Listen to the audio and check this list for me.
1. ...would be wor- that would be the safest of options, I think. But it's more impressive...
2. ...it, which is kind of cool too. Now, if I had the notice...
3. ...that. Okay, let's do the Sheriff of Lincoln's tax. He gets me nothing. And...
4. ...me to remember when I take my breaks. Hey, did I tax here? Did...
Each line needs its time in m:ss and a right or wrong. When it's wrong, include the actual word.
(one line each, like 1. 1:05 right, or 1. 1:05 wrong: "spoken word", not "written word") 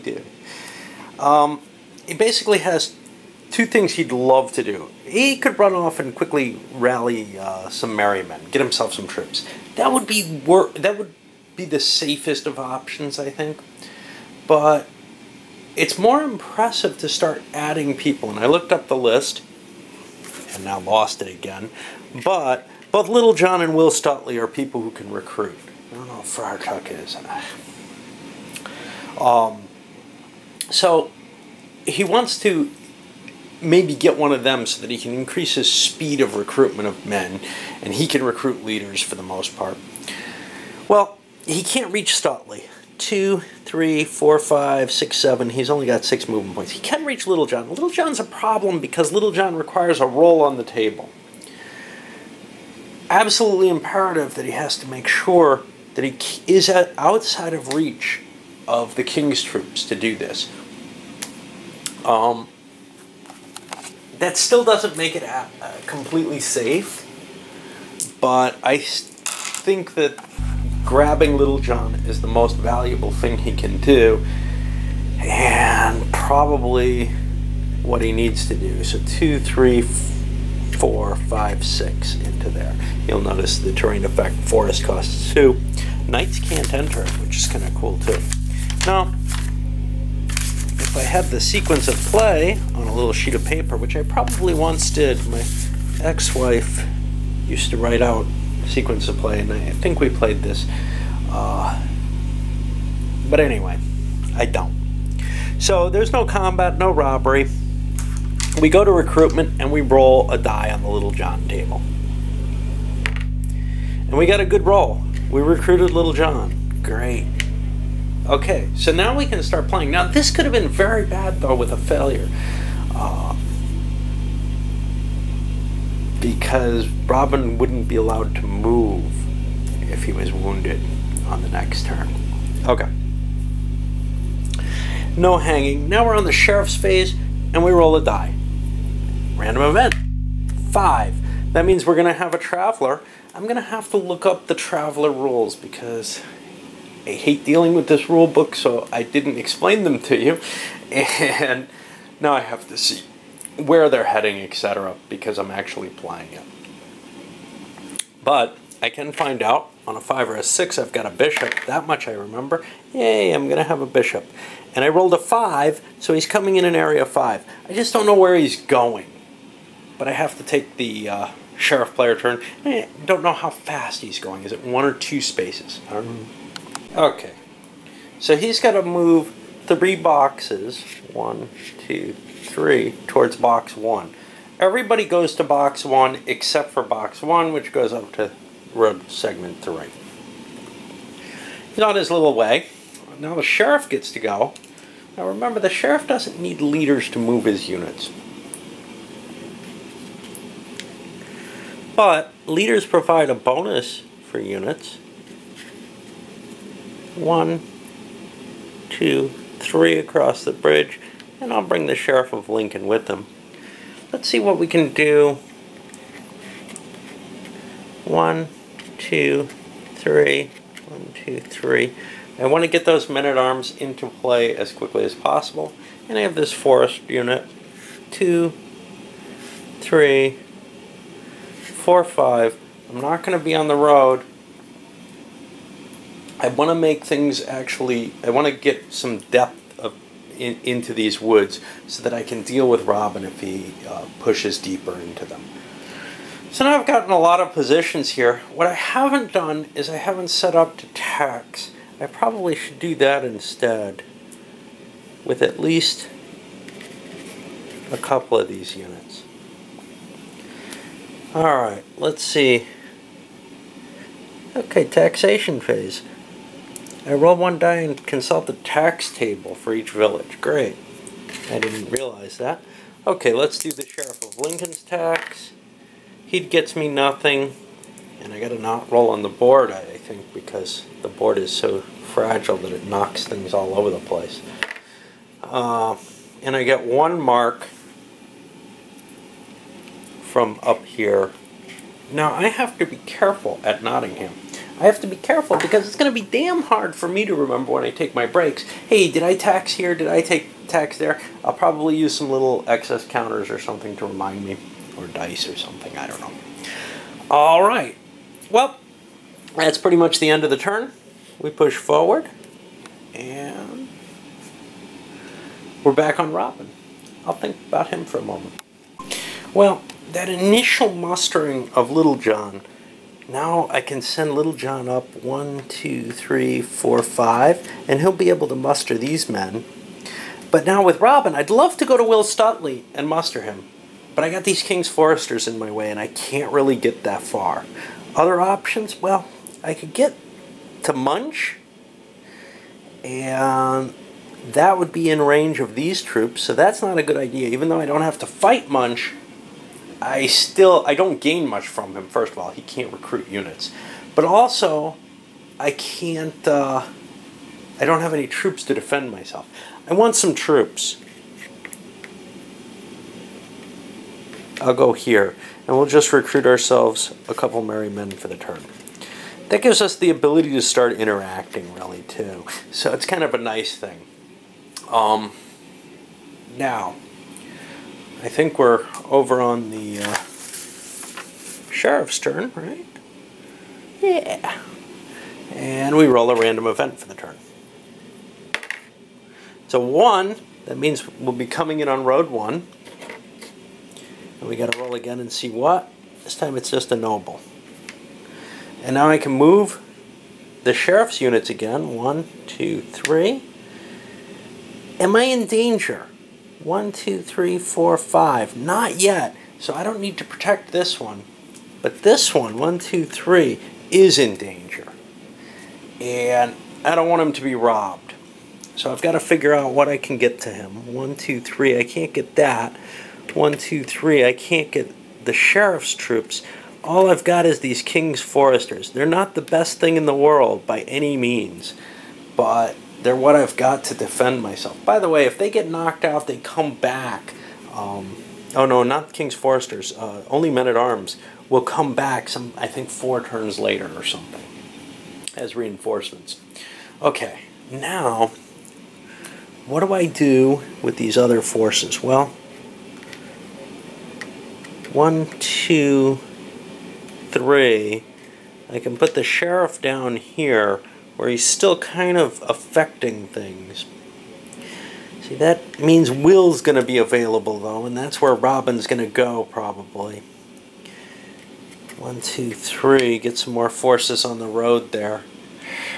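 1. 0:09 right
2. 1:27 wrong: "sequence", not "notice"
3. 4:32 right
4. 4:57 right.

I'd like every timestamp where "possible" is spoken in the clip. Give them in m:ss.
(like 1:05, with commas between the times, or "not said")
3:45.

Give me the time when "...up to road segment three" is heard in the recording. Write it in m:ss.
3:07.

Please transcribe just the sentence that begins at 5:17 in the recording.
I'll think about him for a moment.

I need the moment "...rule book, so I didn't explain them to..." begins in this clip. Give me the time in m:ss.
2:28.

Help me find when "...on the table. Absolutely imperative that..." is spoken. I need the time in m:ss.
0:50.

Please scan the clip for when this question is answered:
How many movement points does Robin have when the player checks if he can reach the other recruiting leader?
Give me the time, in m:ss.
0:46.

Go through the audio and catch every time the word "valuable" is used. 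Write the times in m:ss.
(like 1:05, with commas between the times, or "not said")
1:12.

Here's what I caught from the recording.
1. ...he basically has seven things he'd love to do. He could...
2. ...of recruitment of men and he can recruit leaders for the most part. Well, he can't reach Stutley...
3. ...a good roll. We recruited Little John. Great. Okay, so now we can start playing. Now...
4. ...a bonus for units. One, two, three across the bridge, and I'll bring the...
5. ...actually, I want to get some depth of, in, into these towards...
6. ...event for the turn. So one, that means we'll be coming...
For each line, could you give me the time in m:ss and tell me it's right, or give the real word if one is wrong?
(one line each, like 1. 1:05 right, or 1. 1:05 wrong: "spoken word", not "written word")
1. 0:02 wrong: "two", not "seven"
2. 0:36 right
3. 1:54 right
4. 3:23 right
5. 3:57 wrong: "woods", not "towards"
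6. 6:26 right.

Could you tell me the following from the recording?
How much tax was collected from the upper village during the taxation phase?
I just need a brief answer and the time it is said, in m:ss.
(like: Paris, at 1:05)
1 mark, at 4:46.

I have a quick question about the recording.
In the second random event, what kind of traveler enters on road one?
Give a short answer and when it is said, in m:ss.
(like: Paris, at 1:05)
A noble, at 6:36.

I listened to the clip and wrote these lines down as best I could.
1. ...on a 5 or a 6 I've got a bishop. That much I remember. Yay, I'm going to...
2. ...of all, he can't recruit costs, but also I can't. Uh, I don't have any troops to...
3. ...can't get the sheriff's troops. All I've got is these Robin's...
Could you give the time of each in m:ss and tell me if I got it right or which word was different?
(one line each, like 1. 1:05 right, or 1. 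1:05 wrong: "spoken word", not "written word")
1. 2:39 right
2. 5:52 wrong: "units", not "costs"
3. 7:04 wrong: "King", not "Robin".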